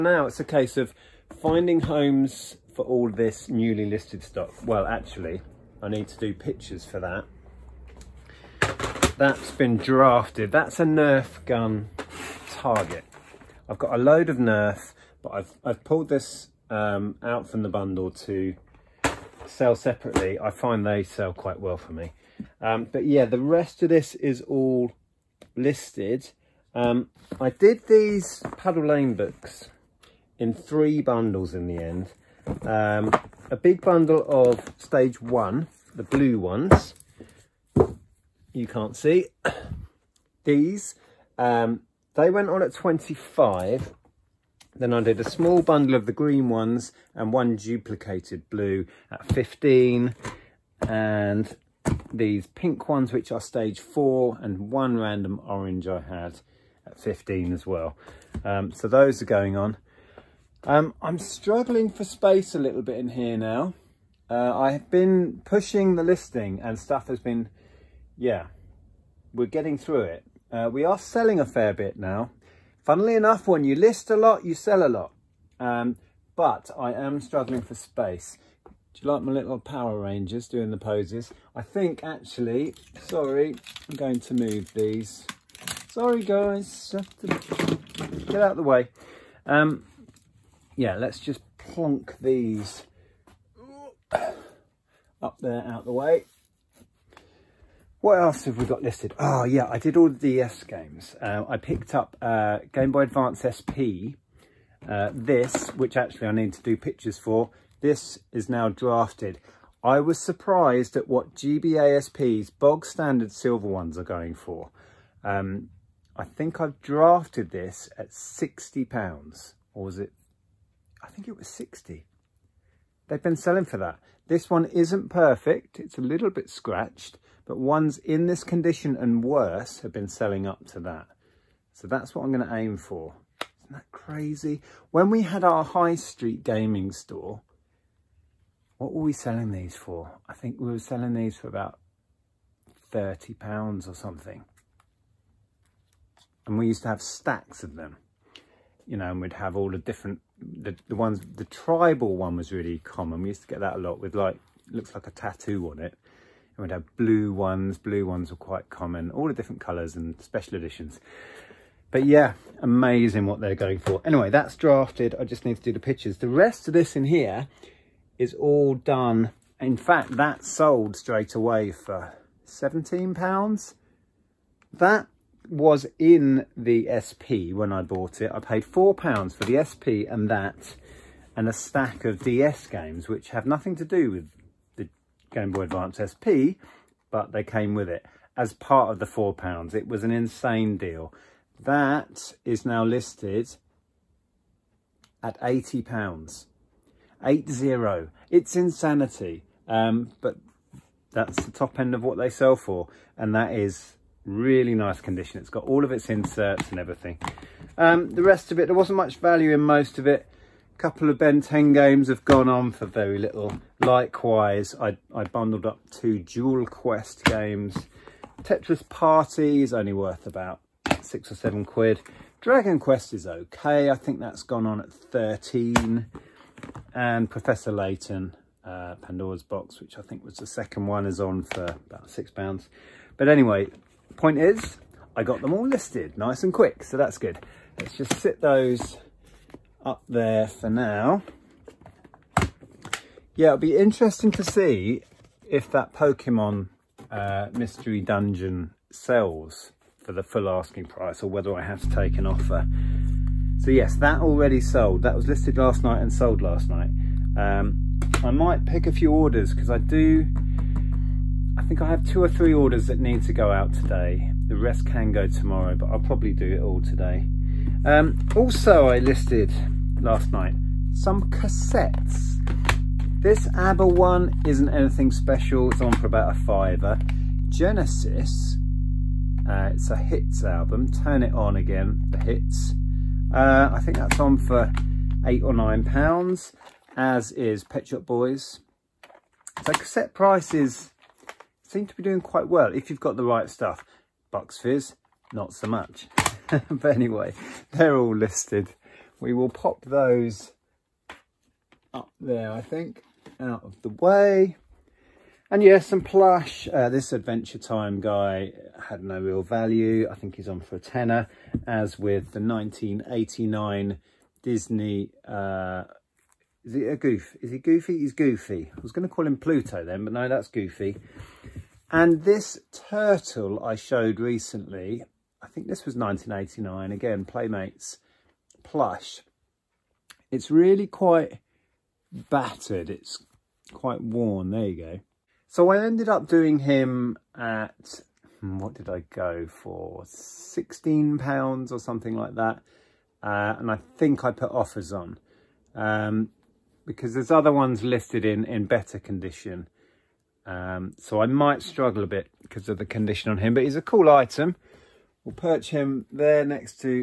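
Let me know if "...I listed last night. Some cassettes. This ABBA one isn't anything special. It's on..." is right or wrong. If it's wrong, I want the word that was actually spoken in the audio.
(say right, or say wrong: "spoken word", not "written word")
right.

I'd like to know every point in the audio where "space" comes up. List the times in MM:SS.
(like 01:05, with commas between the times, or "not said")
01:02, 01:17.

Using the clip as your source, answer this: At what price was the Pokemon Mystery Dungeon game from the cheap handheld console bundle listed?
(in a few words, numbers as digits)
£80.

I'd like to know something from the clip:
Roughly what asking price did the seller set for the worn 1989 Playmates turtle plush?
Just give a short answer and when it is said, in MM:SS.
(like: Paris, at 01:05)
£16, at 05:40.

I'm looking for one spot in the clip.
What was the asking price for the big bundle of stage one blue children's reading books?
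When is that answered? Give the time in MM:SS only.
00:42.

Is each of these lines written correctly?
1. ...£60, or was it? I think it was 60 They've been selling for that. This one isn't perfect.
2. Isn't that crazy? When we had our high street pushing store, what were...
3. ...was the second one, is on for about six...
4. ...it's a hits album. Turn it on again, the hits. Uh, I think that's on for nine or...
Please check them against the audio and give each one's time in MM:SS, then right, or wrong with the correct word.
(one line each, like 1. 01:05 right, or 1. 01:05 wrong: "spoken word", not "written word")
1. 01:58 right
2. 02:13 wrong: "gaming", not "pushing"
3. 03:50 right
4. 04:39 wrong: "eight", not "nine".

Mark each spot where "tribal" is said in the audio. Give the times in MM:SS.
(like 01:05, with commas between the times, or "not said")
02:31.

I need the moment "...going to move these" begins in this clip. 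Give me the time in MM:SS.
01:23.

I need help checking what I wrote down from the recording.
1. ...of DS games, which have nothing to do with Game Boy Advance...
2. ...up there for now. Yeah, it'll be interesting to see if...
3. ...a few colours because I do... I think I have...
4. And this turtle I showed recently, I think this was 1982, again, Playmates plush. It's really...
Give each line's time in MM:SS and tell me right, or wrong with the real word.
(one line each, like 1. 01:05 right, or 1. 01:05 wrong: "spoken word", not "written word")
1. 03:02 right
2. 03:59 right
3. 04:18 wrong: "orders", not "colours"
4. 05:21 wrong: "1989", not "1982".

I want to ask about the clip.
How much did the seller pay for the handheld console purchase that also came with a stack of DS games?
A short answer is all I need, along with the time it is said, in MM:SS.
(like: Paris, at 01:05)
£4, at 02:58.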